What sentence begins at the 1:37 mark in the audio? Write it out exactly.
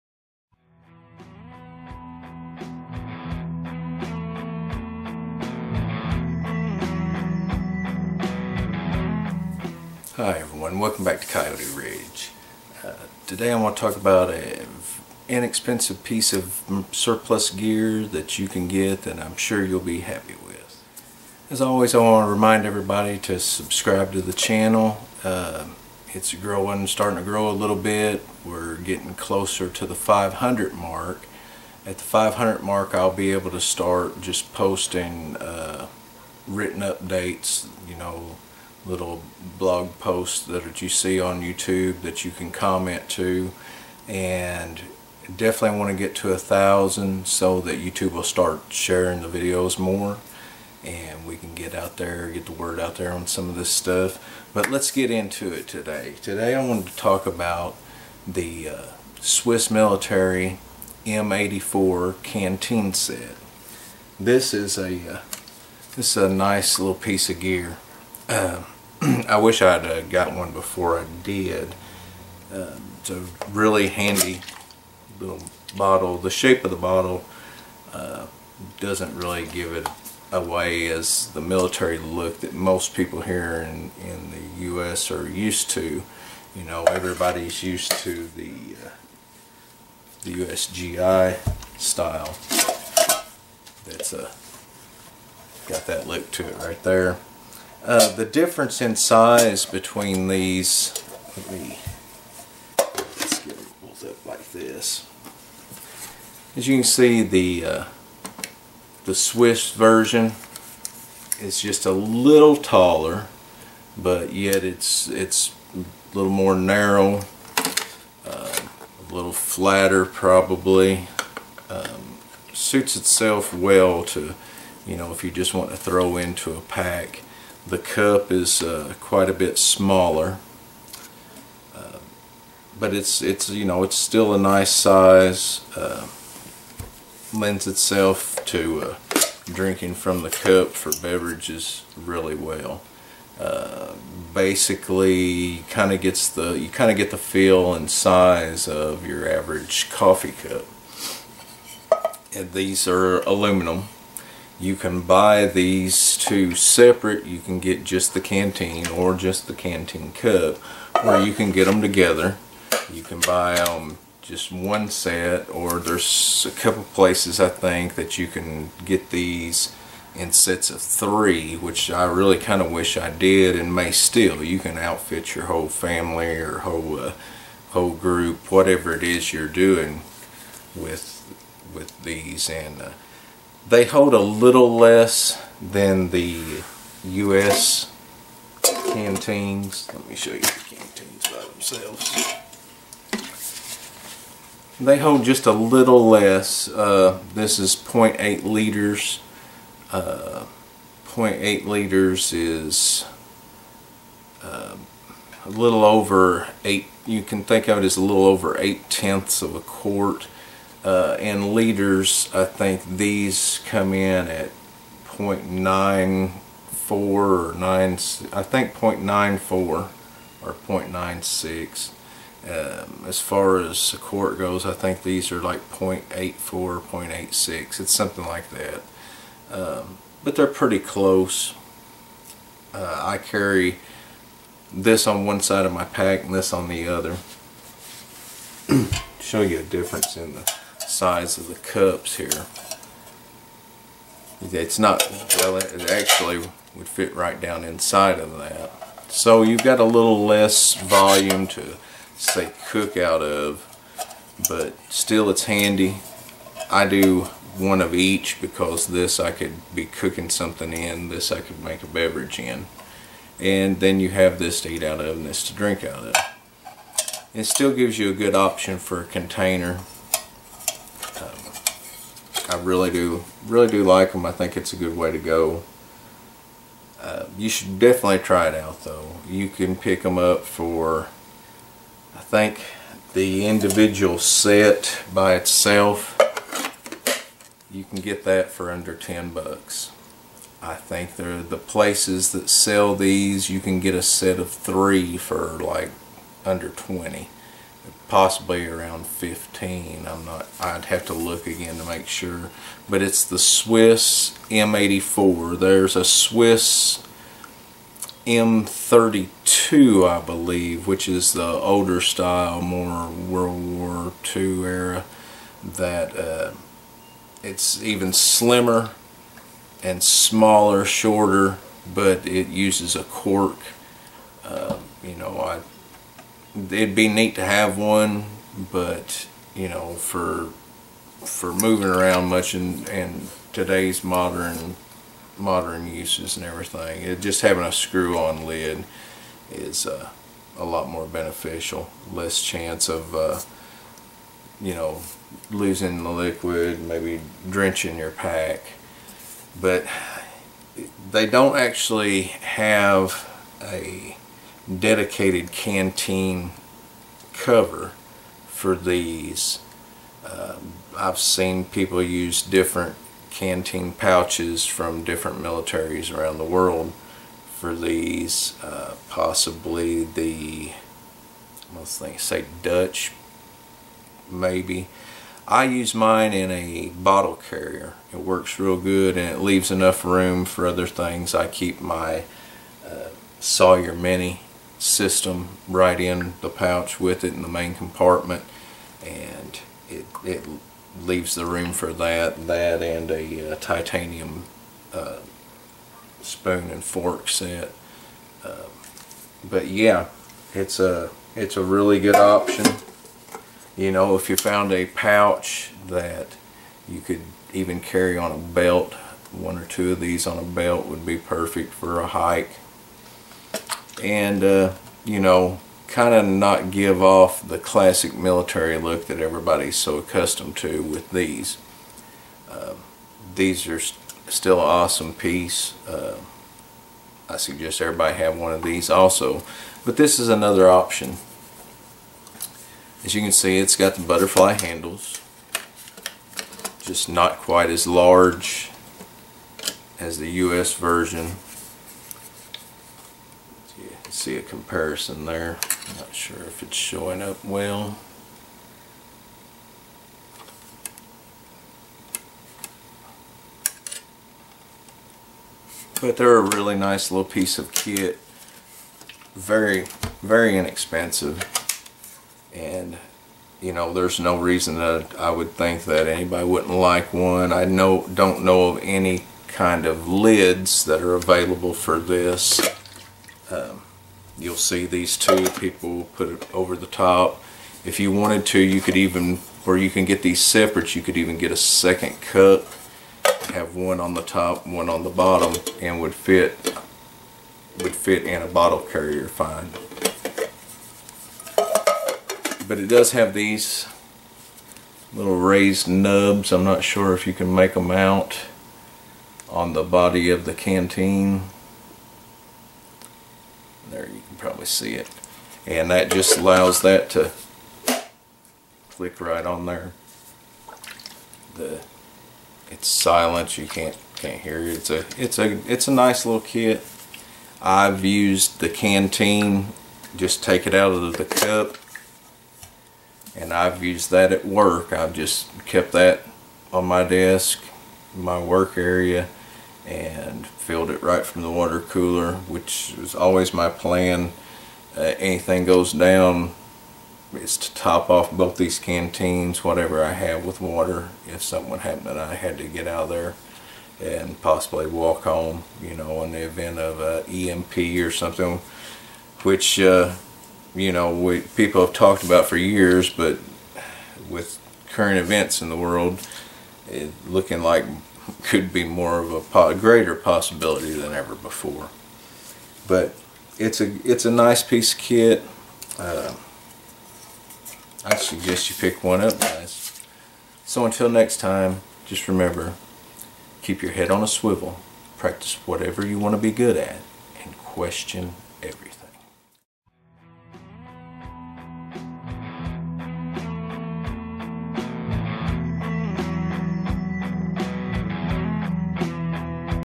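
Uh, the difference in size between these, let me, let's get them pulled up like this.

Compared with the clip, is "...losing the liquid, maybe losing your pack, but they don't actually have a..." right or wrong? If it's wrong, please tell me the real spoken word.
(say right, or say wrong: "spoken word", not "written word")
wrong: "drenching", not "losing".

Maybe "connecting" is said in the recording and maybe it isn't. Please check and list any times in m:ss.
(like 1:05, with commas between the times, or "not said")
not said.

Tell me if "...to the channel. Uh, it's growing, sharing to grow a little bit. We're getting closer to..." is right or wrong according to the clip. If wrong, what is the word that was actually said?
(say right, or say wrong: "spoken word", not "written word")
wrong: "starting", not "sharing".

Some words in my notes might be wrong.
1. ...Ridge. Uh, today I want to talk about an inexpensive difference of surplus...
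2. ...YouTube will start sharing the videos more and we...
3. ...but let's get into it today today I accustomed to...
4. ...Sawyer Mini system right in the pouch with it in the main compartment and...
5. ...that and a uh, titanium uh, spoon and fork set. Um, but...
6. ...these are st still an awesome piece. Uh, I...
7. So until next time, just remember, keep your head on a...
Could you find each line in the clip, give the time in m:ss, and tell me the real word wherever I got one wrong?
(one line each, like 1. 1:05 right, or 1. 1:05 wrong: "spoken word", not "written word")
1. 0:11 wrong: "piece", not "difference"
2. 0:47 right
3. 0:54 wrong: "wanted", not "accustomed"
4. 6:23 right
5. 6:32 right
6. 7:03 right
7. 9:30 right.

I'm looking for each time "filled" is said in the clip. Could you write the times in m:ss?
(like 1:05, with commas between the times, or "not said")
8:50.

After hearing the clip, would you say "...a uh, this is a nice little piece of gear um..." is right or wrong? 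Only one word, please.
right.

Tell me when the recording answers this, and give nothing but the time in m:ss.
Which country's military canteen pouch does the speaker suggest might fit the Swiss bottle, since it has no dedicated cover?
6:12.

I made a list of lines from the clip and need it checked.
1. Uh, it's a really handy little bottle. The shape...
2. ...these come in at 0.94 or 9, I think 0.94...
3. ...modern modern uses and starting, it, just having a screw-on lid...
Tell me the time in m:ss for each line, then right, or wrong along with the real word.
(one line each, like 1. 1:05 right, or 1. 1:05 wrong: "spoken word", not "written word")
1. 1:12 right
2. 3:32 right
3. 5:34 wrong: "everything", not "starting".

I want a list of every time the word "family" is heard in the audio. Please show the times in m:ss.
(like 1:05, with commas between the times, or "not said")
2:55.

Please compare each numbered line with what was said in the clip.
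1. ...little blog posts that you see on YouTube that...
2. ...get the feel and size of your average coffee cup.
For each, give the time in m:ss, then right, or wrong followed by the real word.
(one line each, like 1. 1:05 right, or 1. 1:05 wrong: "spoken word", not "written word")
1. 0:38 right
2. 2:26 right.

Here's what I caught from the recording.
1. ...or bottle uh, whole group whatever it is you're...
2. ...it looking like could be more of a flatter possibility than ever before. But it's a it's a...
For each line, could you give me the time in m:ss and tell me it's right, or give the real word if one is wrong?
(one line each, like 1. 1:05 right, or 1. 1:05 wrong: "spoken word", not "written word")
1. 2:56 wrong: "whole", not "bottle"
2. 9:16 wrong: "greater", not "flatter".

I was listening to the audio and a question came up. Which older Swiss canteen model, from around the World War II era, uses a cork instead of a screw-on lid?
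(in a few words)
M32.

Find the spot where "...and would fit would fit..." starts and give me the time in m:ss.
8:05.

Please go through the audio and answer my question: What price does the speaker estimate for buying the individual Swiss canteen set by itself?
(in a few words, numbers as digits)
under 10 bucks.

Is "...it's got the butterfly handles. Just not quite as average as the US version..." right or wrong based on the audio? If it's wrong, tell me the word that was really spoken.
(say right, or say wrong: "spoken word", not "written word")
wrong: "large", not "average".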